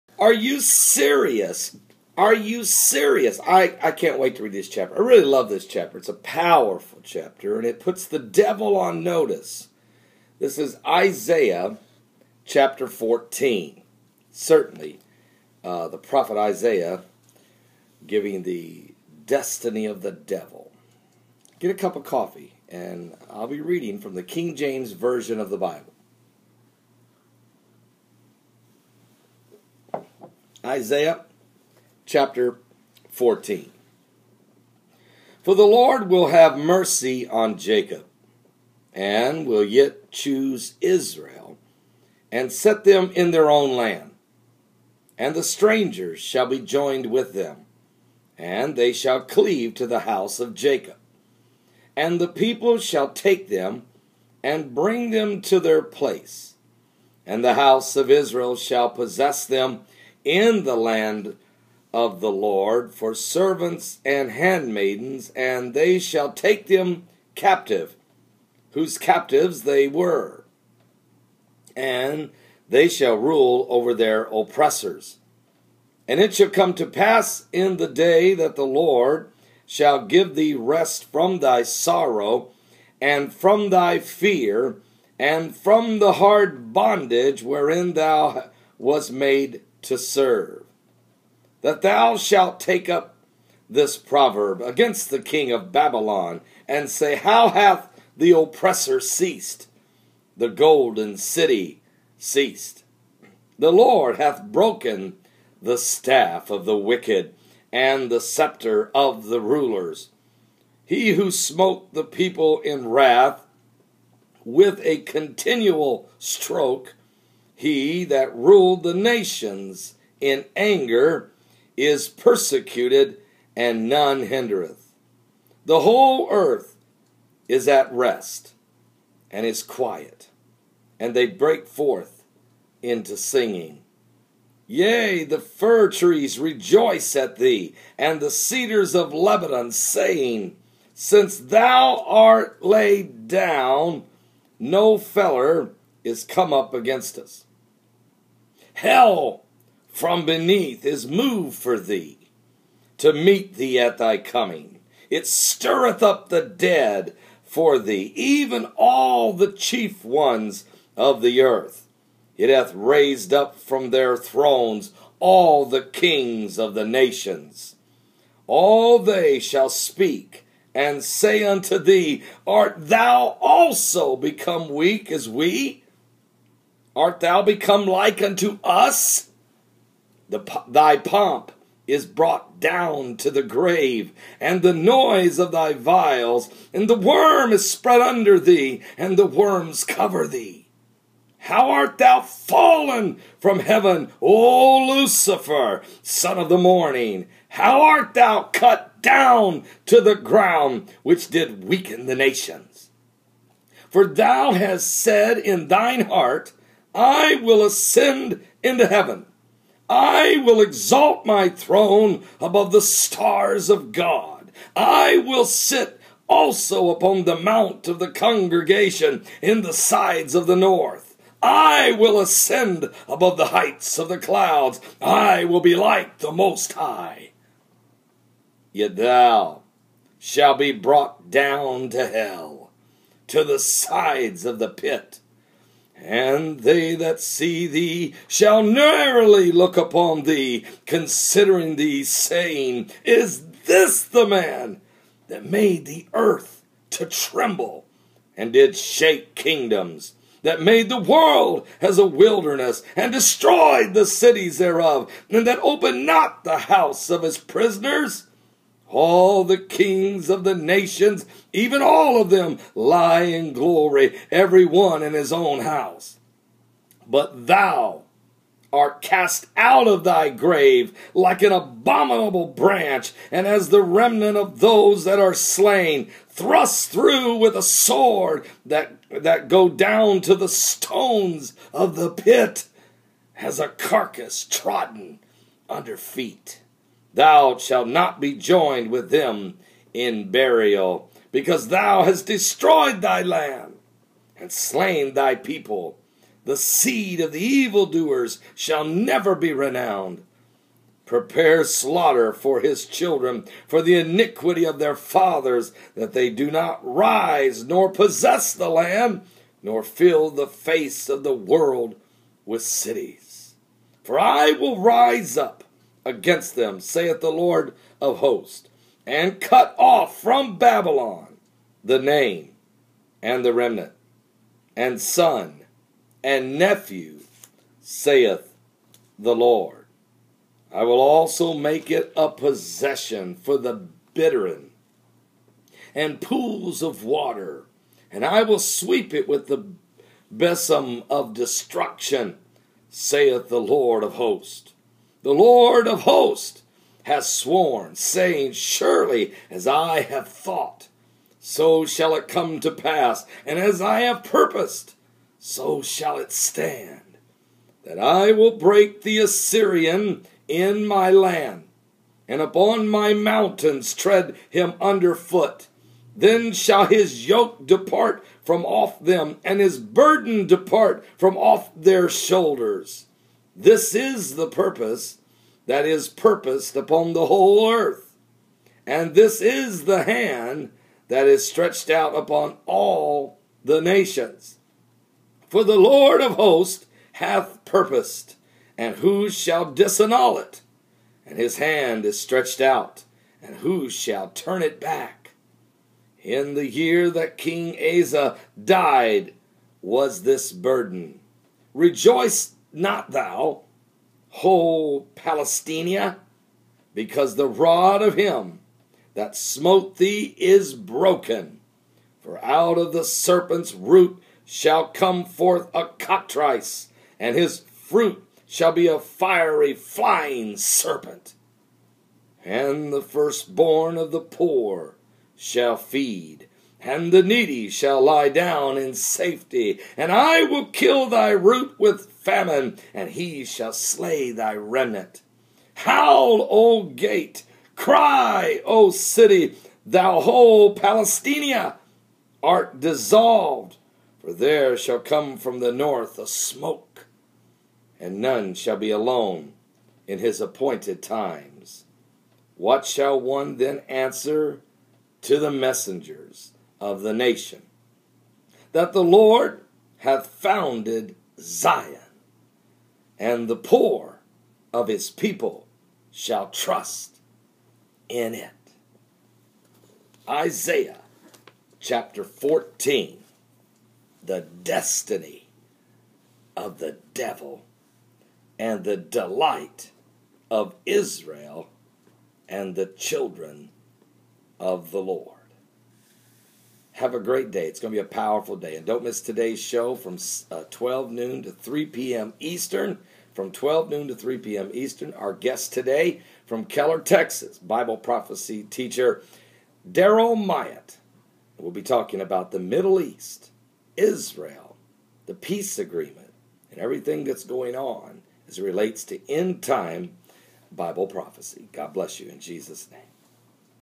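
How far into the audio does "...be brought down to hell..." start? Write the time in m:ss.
3:50.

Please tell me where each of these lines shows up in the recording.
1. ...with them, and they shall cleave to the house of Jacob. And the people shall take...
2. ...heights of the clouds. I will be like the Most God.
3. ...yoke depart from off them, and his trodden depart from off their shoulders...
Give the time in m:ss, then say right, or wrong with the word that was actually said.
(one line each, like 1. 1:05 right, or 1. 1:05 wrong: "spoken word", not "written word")
1. 0:47 right
2. 3:43 wrong: "High", not "God"
3. 6:07 wrong: "burden", not "trodden".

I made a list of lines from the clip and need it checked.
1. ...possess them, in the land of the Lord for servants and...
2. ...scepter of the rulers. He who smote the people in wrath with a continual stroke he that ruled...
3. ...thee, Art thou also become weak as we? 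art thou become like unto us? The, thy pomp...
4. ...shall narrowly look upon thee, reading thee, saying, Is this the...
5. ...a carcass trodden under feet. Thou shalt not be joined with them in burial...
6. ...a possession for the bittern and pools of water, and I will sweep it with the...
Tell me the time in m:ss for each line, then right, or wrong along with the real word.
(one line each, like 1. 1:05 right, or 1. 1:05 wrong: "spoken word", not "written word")
1. 0:58 right
2. 1:48 right
3. 2:51 right
4. 3:58 wrong: "considering", not "reading"
5. 4:43 right
6. 5:32 right.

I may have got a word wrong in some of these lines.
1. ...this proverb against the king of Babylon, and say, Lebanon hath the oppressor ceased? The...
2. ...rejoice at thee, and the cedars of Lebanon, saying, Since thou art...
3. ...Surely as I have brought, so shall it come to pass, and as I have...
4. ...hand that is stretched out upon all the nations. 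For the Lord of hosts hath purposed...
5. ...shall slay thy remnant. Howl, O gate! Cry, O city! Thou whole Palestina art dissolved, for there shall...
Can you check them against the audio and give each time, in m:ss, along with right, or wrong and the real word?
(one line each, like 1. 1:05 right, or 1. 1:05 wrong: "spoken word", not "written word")
1. 1:33 wrong: "How", not "Lebanon"
2. 2:16 right
3. 5:48 wrong: "thought", not "brought"
4. 6:20 right
5. 7:13 right.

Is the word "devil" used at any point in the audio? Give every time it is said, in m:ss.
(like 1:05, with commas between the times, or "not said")
0:08, 0:20, 7:57.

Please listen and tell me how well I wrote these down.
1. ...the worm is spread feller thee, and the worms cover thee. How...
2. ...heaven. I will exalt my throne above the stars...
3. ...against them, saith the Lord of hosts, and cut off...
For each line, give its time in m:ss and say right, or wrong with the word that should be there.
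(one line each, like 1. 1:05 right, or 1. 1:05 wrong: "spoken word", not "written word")
1. 3:06 wrong: "under", not "feller"
2. 3:28 right
3. 5:16 right.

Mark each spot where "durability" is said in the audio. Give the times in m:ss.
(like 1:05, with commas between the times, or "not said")
not said.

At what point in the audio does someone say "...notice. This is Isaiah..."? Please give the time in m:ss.
0:09.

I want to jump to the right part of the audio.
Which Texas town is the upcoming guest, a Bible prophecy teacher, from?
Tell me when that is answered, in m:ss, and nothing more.
8:16.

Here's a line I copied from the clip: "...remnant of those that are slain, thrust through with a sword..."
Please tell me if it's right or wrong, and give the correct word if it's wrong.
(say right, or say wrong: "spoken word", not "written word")
right.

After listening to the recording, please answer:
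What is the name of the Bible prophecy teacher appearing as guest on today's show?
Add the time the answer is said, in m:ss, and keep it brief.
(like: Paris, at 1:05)
Daryl Myatt, at 8:19.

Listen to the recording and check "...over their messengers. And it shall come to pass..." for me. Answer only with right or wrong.
wrong.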